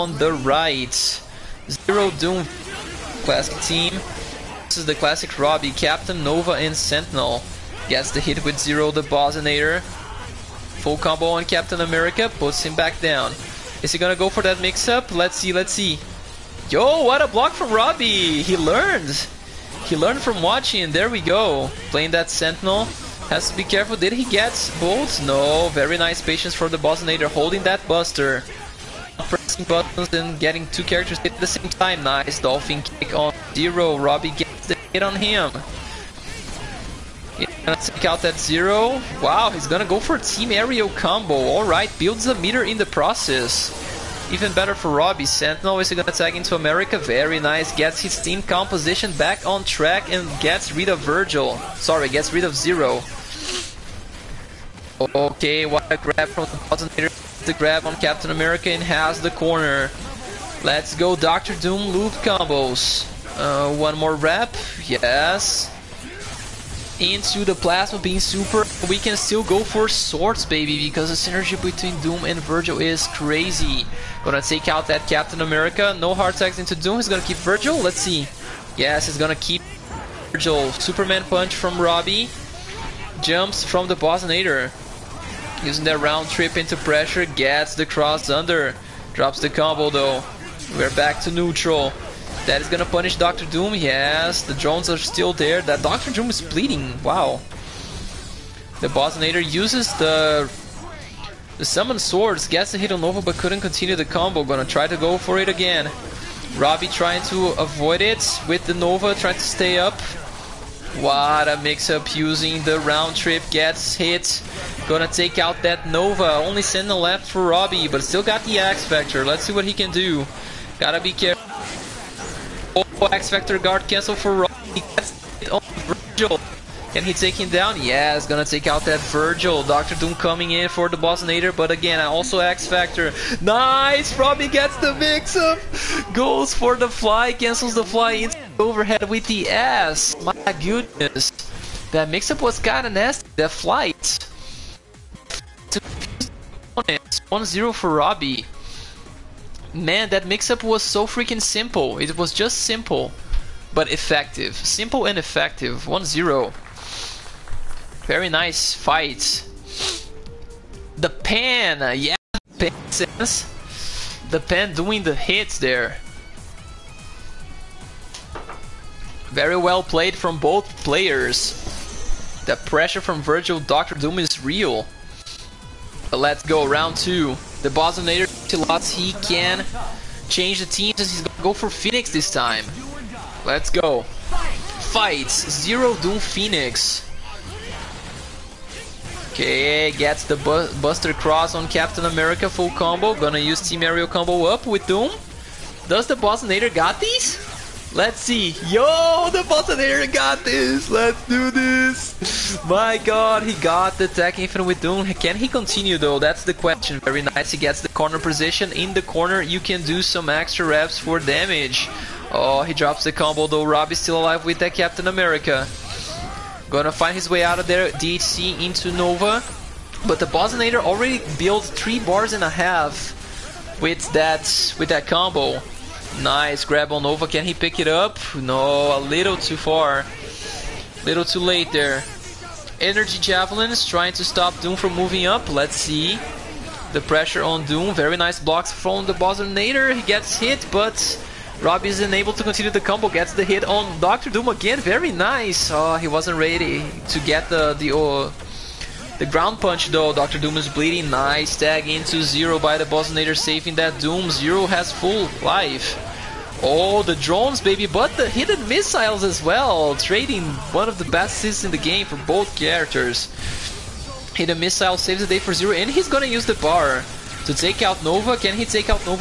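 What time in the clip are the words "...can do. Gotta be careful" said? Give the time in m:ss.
1:59.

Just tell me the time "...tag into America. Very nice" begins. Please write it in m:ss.
0:46.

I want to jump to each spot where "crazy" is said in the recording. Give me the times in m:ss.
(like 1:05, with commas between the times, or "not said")
1:13.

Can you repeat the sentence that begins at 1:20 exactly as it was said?
Superman Punch from Robbie, jumps from the nader.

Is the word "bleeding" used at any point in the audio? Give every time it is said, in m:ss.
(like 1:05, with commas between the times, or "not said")
1:36, 4:10.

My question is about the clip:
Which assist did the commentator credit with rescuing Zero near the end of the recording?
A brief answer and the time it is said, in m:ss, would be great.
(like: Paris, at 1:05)
Hidden missile, at 4:24.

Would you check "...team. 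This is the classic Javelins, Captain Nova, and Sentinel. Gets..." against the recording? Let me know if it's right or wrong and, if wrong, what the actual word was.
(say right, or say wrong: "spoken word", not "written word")
wrong: "Robbie", not "Javelins".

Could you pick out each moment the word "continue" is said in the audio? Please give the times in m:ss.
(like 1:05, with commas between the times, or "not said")
1:43, 3:25, 4:02.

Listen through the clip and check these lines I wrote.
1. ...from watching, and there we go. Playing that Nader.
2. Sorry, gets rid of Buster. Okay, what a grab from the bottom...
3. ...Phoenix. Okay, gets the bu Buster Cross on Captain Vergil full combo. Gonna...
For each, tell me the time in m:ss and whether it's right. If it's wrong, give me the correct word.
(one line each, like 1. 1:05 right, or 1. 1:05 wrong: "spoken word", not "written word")
1. 0:20 wrong: "Sentinel", not "Nader"
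2. 0:51 wrong: "Zero", not "Buster"
3. 3:06 wrong: "America", not "Vergil".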